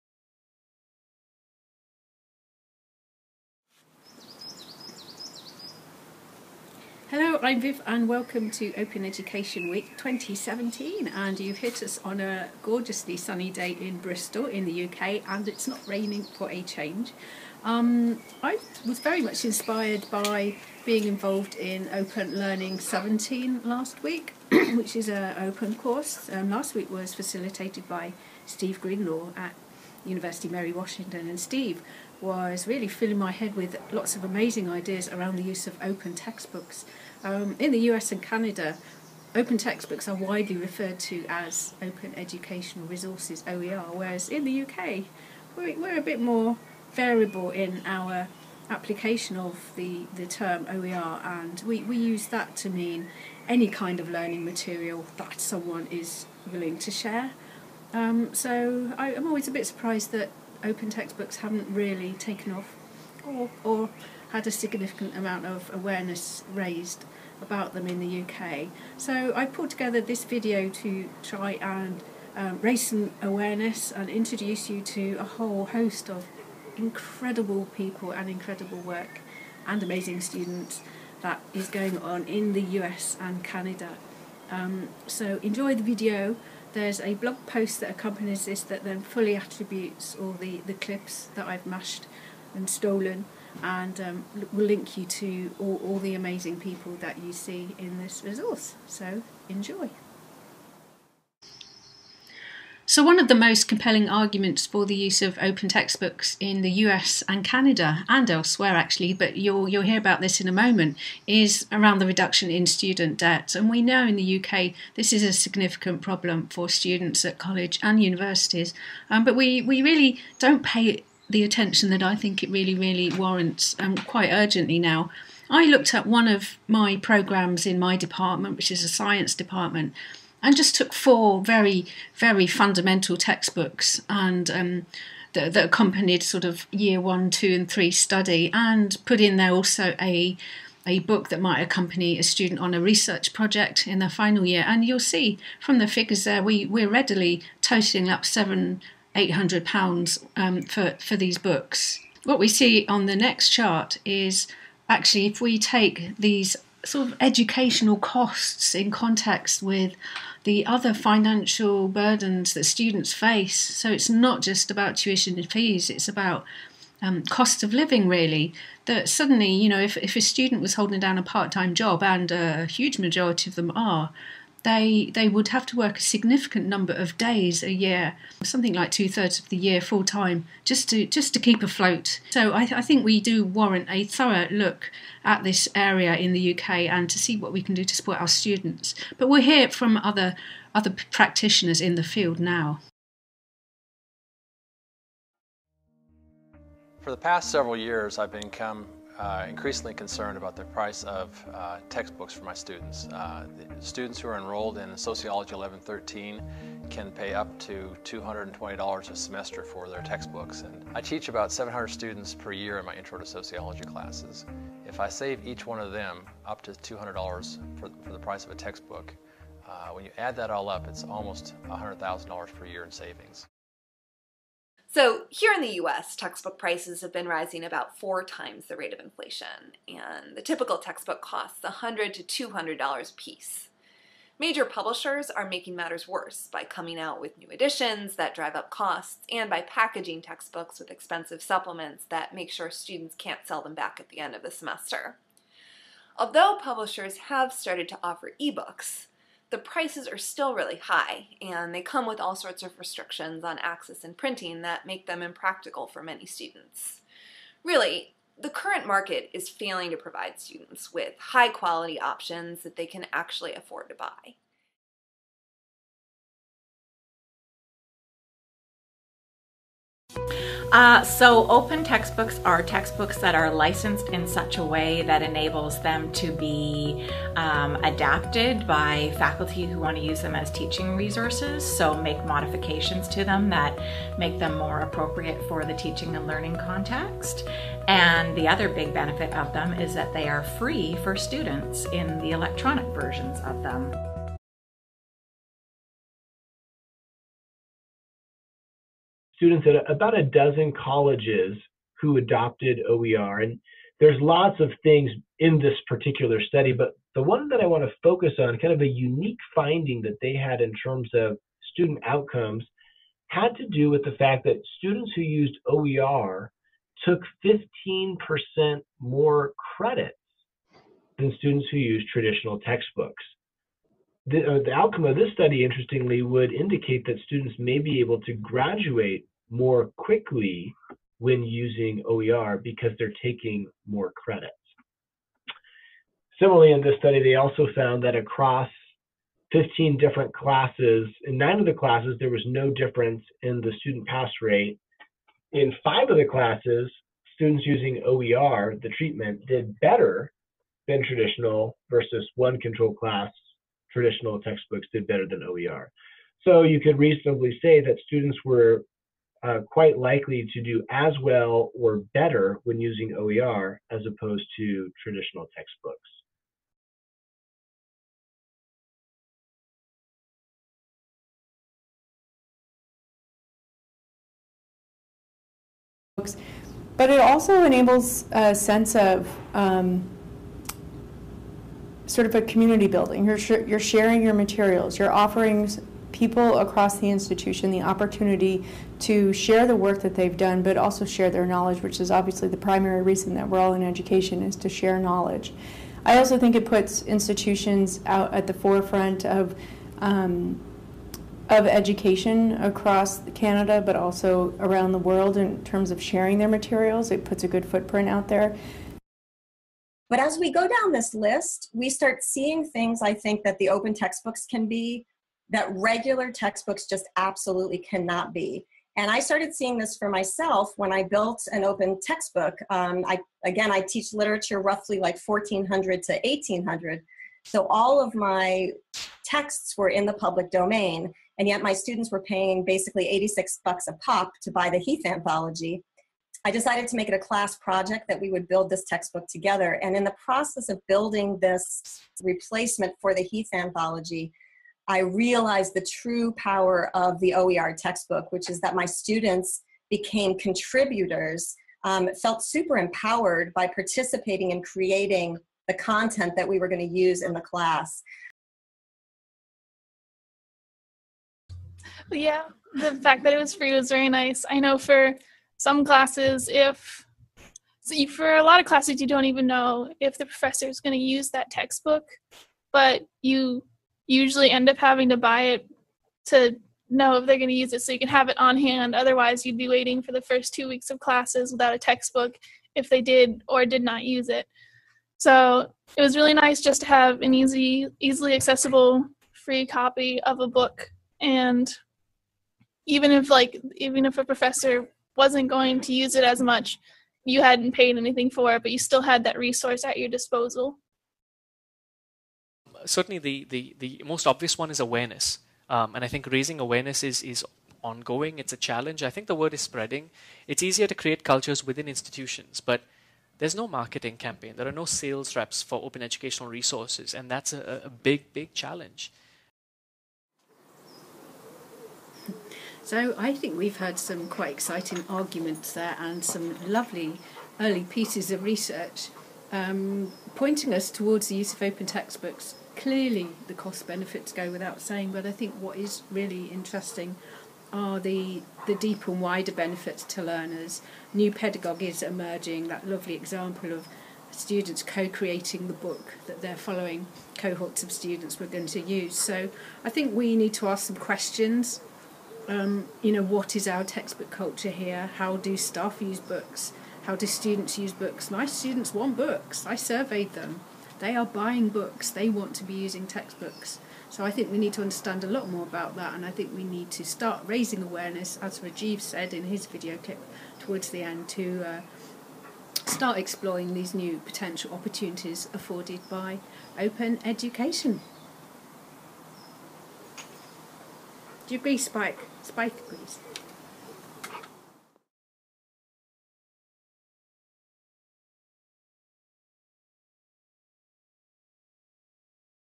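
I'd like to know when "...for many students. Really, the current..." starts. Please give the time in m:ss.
4:15.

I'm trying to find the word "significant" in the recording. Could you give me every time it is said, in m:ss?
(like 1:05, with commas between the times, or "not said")
1:04, 1:55, 2:56.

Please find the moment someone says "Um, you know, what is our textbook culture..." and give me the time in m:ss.
9:12.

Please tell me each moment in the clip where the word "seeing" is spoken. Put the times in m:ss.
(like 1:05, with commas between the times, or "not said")
6:52, 6:59.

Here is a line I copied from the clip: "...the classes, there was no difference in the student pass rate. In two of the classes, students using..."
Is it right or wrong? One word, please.
wrong.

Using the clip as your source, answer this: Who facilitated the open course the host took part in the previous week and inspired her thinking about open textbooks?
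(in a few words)
Steve Greenlaw.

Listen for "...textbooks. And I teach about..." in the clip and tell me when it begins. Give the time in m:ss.
3:30.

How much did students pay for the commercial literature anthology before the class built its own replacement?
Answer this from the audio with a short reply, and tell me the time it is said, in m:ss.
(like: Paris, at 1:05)
86 bucks, at 7:13.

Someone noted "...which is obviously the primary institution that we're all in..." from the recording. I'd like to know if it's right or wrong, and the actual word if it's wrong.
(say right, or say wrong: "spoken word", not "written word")
wrong: "reason", not "institution".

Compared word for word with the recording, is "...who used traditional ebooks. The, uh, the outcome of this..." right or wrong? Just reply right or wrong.
wrong.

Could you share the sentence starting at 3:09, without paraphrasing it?
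But we'll hear from other other practitioners in the field now.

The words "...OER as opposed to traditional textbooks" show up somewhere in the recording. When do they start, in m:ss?
6:03.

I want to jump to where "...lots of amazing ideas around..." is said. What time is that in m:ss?
0:33.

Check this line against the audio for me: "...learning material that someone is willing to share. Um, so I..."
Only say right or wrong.
right.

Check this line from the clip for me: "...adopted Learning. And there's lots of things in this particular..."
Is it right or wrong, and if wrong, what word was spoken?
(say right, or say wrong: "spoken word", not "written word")
wrong: "OER", not "Learning".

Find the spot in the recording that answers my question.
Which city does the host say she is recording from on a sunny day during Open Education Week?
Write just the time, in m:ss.
0:13.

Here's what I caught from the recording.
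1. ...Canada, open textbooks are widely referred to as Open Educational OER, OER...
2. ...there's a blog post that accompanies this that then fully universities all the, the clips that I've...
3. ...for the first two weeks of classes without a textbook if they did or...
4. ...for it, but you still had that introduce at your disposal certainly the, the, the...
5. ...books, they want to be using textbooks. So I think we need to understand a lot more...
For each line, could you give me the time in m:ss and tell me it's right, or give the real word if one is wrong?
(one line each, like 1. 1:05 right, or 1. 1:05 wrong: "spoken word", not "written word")
1. 0:38 wrong: "Resources", not "OER"
2. 1:26 wrong: "attributes", not "universities"
3. 8:00 right
4. 8:18 wrong: "resource", not "introduce"
5. 9:21 right.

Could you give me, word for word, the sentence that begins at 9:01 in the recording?
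New pedagogies emerging, that lovely example of students co creating the book that they're following cohorts of students were going to use.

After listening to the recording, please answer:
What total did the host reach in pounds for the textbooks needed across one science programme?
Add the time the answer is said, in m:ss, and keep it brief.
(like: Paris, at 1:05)
700 to 800 pounds, at 2:28.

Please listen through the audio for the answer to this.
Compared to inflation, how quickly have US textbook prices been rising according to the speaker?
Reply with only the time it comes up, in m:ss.
3:47.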